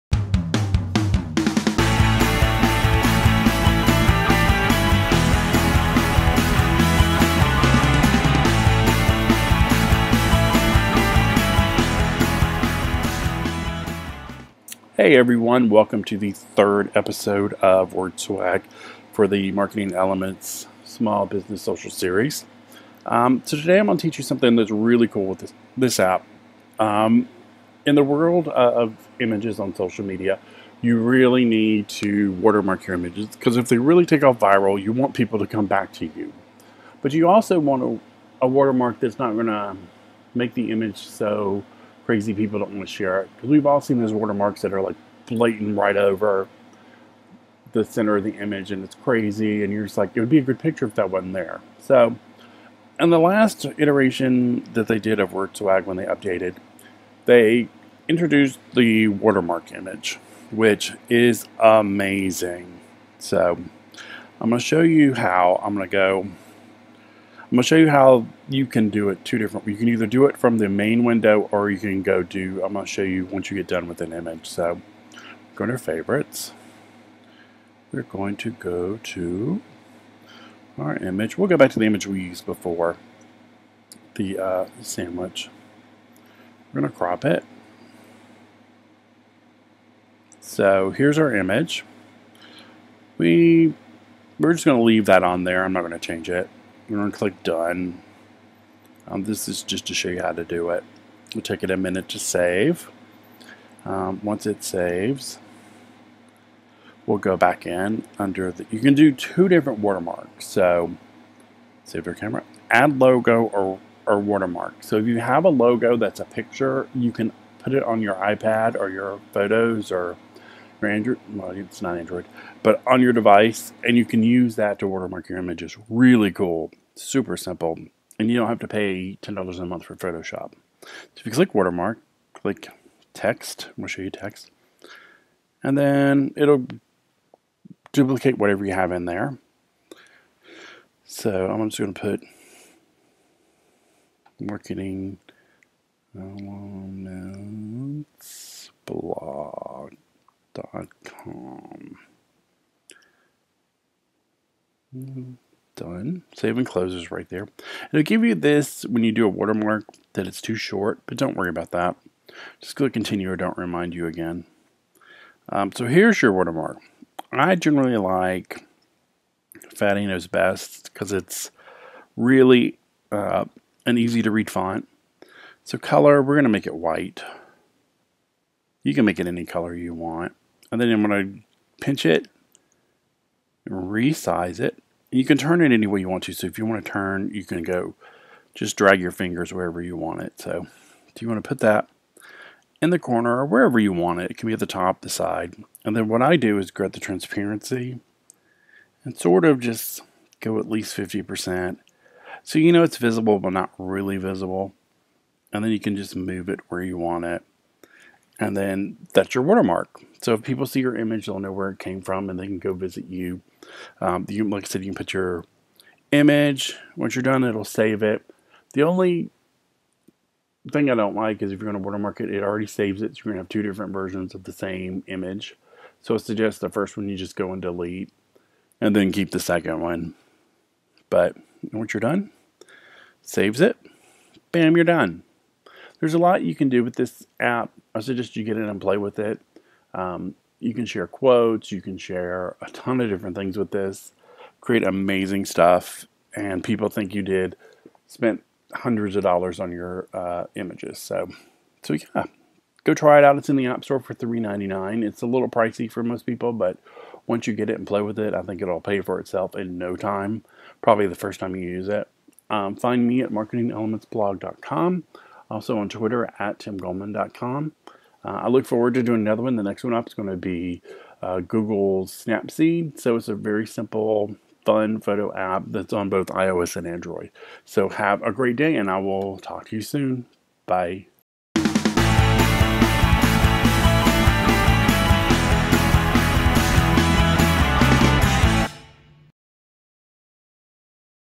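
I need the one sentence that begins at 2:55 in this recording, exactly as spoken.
So color, we're going to make it white.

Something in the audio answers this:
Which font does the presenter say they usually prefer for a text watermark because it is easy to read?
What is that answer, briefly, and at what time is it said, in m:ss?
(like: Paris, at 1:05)
Fat Eno's, at 2:49.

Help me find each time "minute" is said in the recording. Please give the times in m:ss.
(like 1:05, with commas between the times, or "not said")
1:41.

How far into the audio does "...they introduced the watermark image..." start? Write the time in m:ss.
0:57.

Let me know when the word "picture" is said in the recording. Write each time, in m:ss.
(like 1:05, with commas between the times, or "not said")
0:50, 1:56.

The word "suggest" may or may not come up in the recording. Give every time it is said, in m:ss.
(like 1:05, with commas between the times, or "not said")
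3:46, 3:57.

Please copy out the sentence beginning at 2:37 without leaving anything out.
It'll give you this when you do a watermark that it's too short, but don't worry about that.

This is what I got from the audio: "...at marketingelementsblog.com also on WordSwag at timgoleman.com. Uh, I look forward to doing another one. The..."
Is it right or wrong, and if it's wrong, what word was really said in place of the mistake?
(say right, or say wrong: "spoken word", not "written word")
wrong: "Twitter", not "WordSwag".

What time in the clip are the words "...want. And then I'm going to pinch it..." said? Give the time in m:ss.
2:59.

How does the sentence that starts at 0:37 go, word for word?
But you also want a, a watermark that's not going to make the image so crazy people don't want to share it.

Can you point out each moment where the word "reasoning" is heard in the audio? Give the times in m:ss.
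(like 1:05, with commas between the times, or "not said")
not said.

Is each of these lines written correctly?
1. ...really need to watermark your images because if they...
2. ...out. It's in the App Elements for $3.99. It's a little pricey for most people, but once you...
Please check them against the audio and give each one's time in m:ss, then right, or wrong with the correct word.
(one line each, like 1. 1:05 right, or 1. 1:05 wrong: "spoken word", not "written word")
1. 0:30 right
2. 4:13 wrong: "Store", not "Elements".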